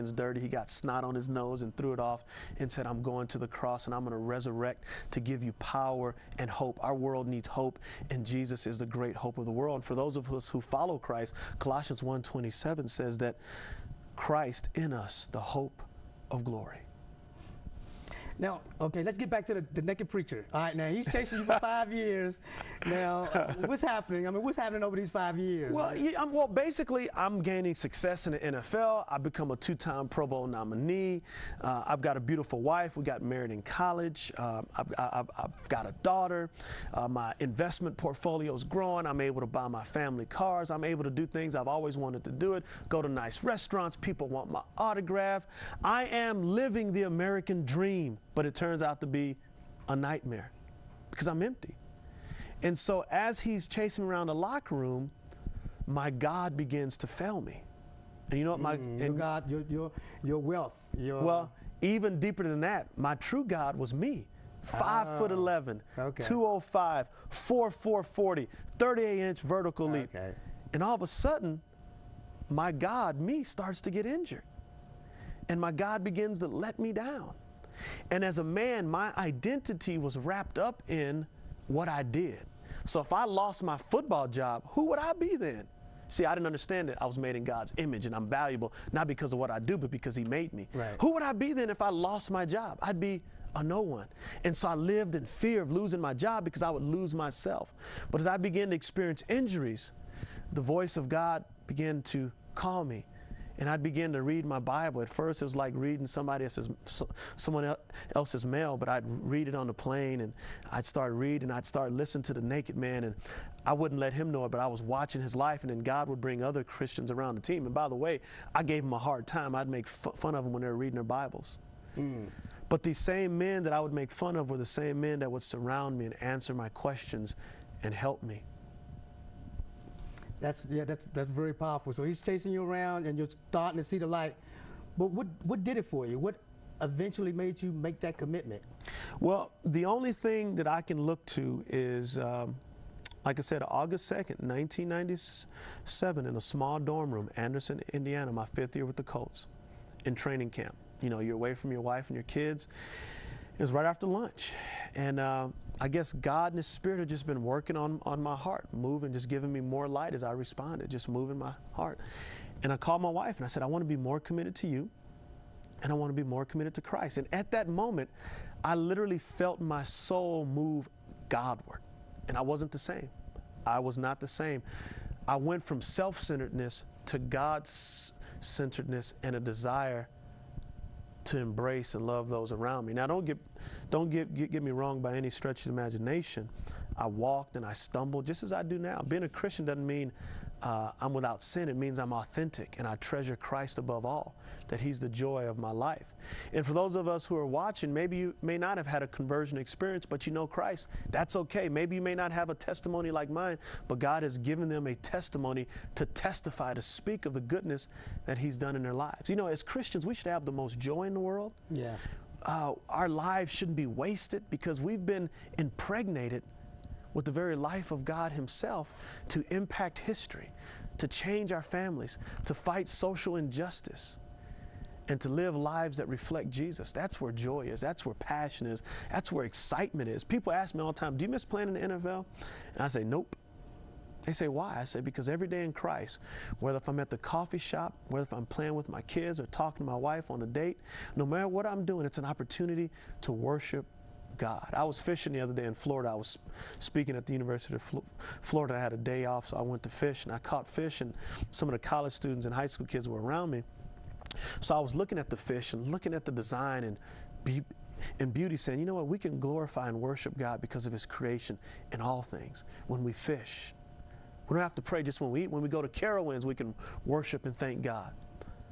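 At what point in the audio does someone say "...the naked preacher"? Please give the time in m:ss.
0:19.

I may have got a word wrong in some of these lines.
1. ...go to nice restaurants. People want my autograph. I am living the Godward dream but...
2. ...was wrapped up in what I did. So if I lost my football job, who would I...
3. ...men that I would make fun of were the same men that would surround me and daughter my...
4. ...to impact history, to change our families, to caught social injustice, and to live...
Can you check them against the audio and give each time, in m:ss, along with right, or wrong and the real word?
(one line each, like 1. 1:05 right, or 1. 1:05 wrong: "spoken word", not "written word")
1. 0:42 wrong: "American", not "Godward"
2. 1:19 right
3. 2:03 wrong: "answer", not "daughter"
4. 3:39 wrong: "fight", not "caught".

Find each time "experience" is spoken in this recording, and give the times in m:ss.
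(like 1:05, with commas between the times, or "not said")
1:38, 3:19.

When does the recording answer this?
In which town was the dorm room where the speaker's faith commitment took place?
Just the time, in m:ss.
2:27.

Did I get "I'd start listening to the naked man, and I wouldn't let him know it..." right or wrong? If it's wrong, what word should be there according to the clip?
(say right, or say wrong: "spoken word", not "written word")
right.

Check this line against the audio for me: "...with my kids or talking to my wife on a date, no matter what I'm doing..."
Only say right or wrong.
right.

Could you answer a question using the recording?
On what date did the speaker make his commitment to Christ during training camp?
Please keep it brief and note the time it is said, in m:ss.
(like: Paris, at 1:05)
August 2, 1997, at 2:23.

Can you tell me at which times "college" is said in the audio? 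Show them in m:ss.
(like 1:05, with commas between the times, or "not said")
0:33, 4:11.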